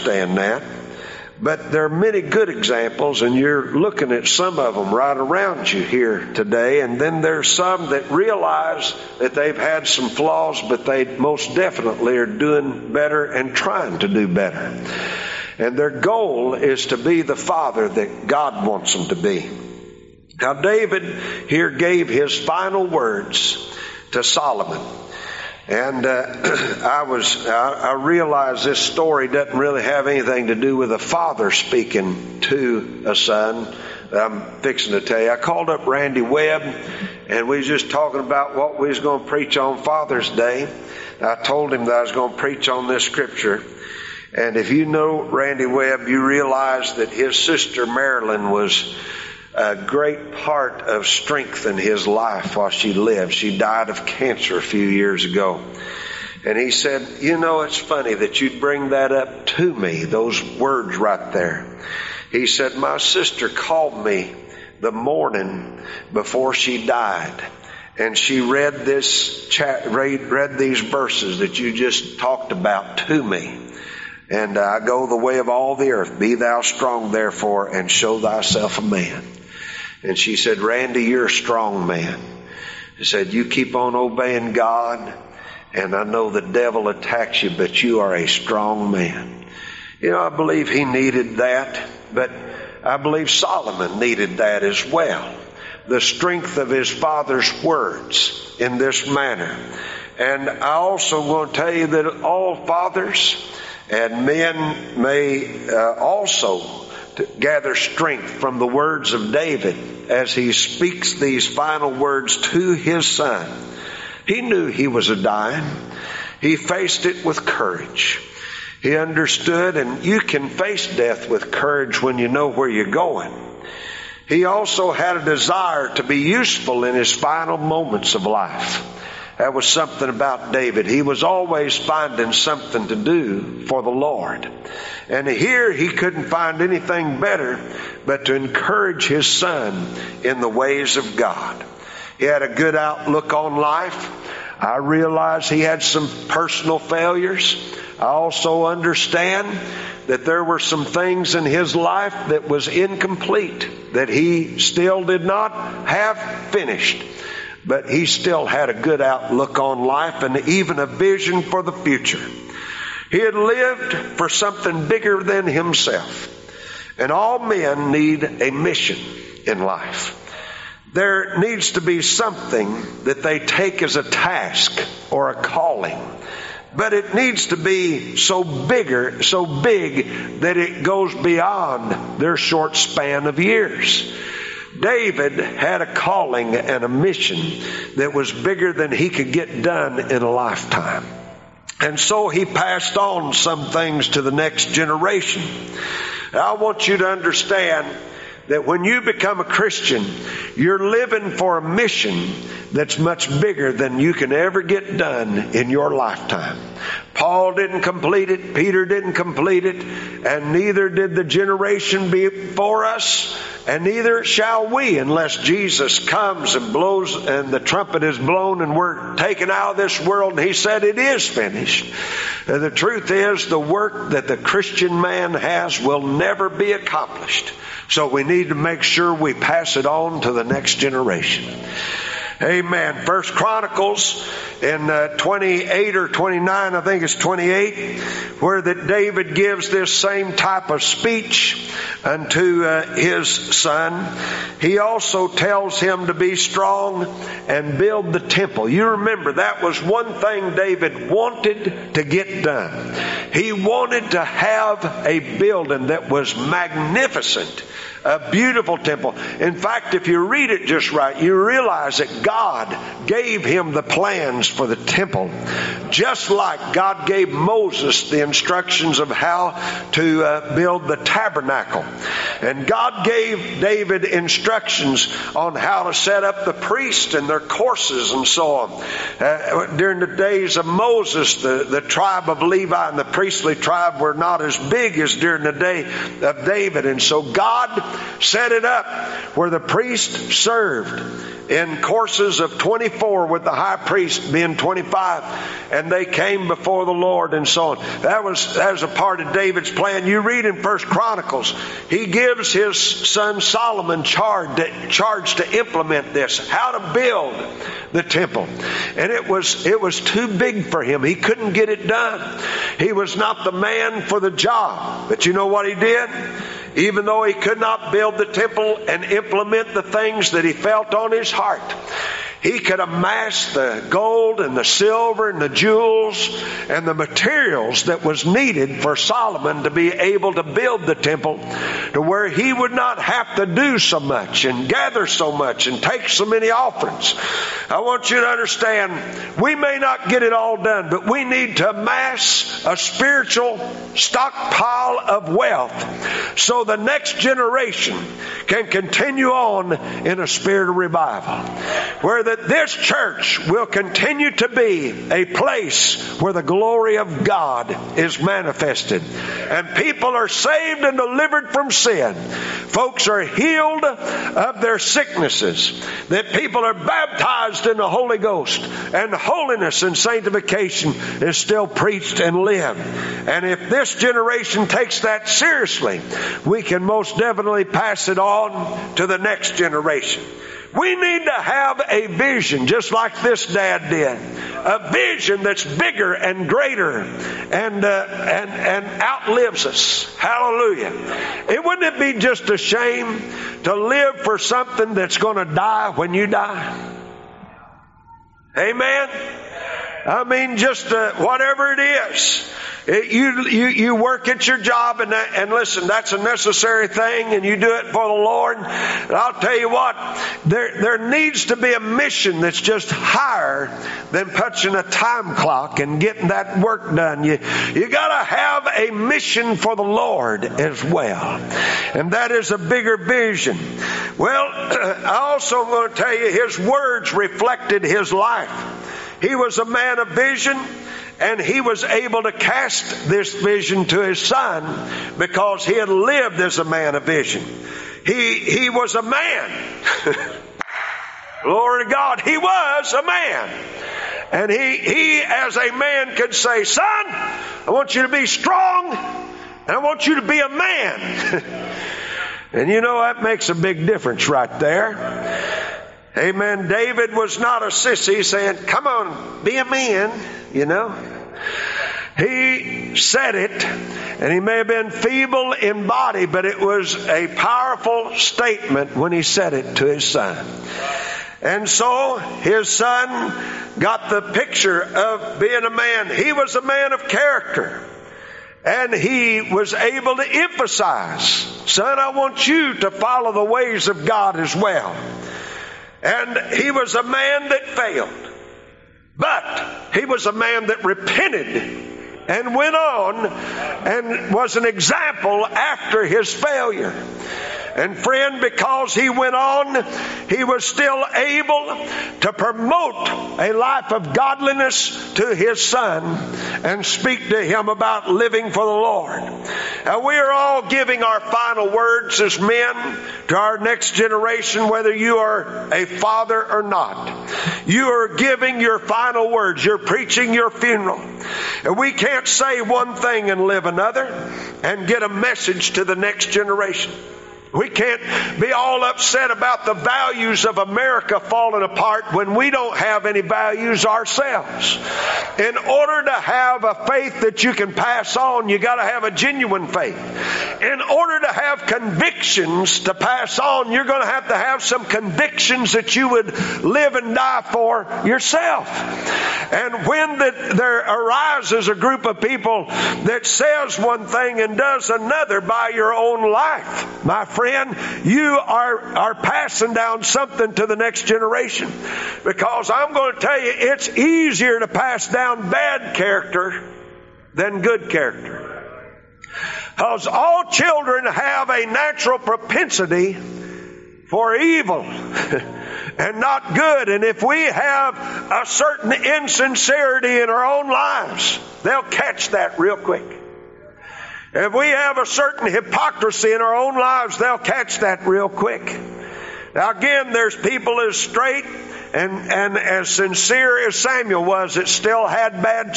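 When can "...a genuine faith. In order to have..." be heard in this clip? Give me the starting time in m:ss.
8:59.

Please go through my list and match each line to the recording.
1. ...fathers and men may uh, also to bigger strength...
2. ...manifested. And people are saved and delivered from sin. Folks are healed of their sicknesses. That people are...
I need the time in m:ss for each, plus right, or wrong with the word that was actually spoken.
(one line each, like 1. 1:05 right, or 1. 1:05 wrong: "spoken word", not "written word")
1. 1:42 wrong: "gather", not "bigger"
2. 5:58 right.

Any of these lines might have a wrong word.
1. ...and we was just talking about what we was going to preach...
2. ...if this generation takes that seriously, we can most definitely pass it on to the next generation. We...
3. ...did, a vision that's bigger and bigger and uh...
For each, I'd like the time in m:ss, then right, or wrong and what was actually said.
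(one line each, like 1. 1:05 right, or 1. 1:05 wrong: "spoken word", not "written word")
1. 0:37 right
2. 6:13 right
3. 6:23 wrong: "greater", not "bigger".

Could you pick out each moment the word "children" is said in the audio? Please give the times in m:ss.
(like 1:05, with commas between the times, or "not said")
9:30.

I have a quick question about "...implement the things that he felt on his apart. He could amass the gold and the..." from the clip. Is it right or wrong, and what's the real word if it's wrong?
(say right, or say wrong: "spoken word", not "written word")
wrong: "heart", not "apart".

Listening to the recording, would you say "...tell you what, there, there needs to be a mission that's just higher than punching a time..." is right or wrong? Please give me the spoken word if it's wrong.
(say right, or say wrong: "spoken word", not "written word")
right.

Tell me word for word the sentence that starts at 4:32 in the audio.
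And God gave David instructions on how to set up the priests and their courses and so on.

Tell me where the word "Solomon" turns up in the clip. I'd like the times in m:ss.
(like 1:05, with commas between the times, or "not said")
0:24, 1:33, 5:03, 5:28.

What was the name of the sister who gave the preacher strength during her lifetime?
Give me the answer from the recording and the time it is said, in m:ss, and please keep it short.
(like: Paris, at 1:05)
Marilyn, at 0:47.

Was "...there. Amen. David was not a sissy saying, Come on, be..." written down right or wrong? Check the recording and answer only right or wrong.
right.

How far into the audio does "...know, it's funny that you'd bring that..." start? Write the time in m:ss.
0:57.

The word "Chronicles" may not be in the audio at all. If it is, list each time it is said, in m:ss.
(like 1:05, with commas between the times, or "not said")
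3:53, 5:00.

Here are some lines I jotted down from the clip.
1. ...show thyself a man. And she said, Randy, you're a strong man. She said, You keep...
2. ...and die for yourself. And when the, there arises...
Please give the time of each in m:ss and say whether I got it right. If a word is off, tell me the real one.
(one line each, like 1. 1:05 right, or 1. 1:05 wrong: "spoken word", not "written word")
1. 1:17 right
2. 9:06 right.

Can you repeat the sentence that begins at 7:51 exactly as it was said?
And so his son got the picture of being a man.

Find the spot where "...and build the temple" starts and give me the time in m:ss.
4:07.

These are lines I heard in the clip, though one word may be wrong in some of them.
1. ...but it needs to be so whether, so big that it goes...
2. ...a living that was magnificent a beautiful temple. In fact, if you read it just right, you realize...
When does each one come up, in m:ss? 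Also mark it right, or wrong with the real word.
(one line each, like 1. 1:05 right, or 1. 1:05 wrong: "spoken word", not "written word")
1. 2:56 wrong: "bigger", not "whether"
2. 4:15 wrong: "building", not "living".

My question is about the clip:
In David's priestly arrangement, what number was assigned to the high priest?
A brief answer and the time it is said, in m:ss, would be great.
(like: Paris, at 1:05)
25, at 4:54.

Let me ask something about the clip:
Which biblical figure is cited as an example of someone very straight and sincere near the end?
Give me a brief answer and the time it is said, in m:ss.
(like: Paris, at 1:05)
Samuel, at 9:53.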